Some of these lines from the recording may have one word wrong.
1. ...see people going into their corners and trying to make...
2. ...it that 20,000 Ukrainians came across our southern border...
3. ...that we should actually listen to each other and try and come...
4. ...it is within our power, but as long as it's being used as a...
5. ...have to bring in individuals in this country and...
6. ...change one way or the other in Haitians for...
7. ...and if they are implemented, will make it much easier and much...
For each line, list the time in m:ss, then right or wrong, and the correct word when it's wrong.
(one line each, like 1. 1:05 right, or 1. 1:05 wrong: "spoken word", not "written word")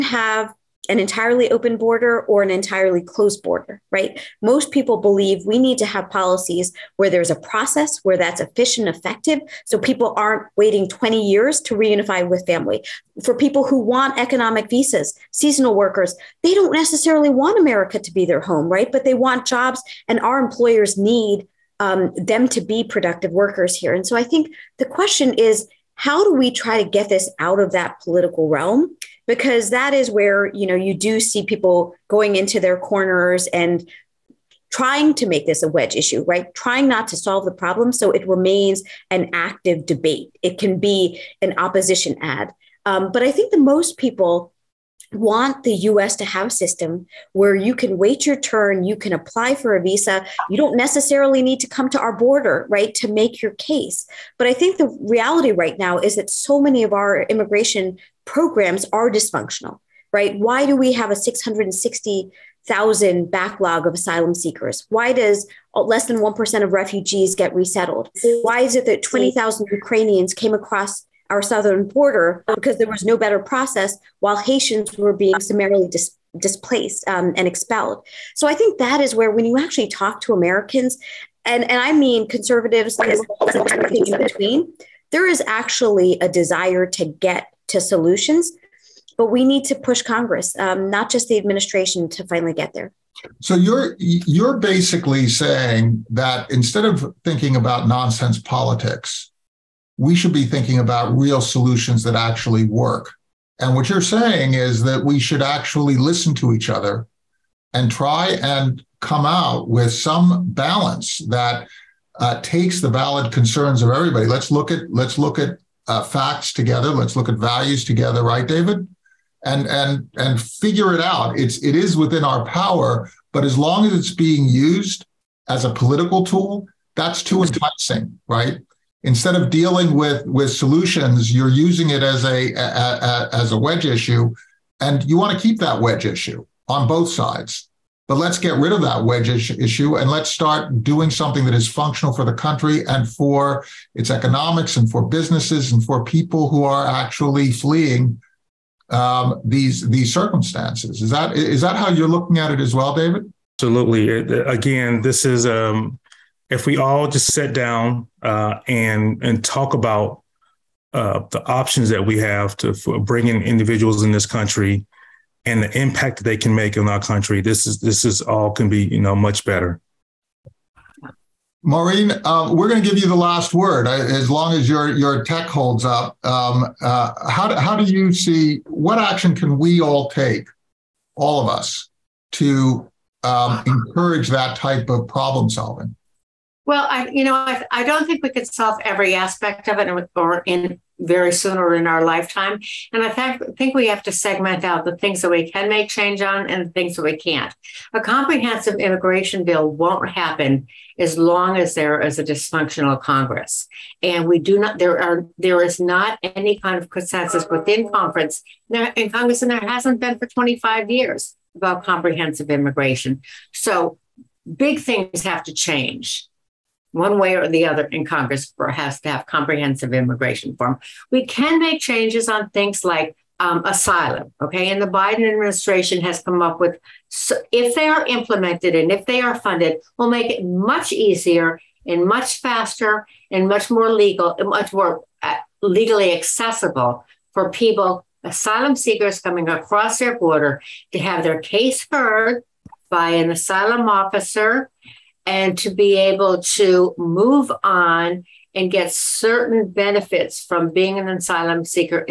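1. 0:31 right
2. 1:08 right
3. 1:44 right
4. 2:01 right
5. 2:42 right
6. 3:35 wrong: "Congress", not "Haitians"
7. 3:48 wrong: "funded", not "implemented".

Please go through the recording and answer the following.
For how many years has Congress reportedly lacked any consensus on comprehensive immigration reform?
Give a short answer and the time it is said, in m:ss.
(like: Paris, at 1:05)
25 years, at 3:30.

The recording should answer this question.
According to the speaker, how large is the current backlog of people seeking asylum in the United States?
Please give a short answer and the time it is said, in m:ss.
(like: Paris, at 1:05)
660,000, at 1:01.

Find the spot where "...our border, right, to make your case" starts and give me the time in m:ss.
0:51.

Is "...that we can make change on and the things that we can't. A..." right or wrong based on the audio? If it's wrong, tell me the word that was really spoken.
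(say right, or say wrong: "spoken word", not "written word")
right.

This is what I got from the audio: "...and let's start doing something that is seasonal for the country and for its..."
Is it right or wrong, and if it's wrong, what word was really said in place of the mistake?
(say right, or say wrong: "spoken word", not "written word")
wrong: "functional", not "seasonal".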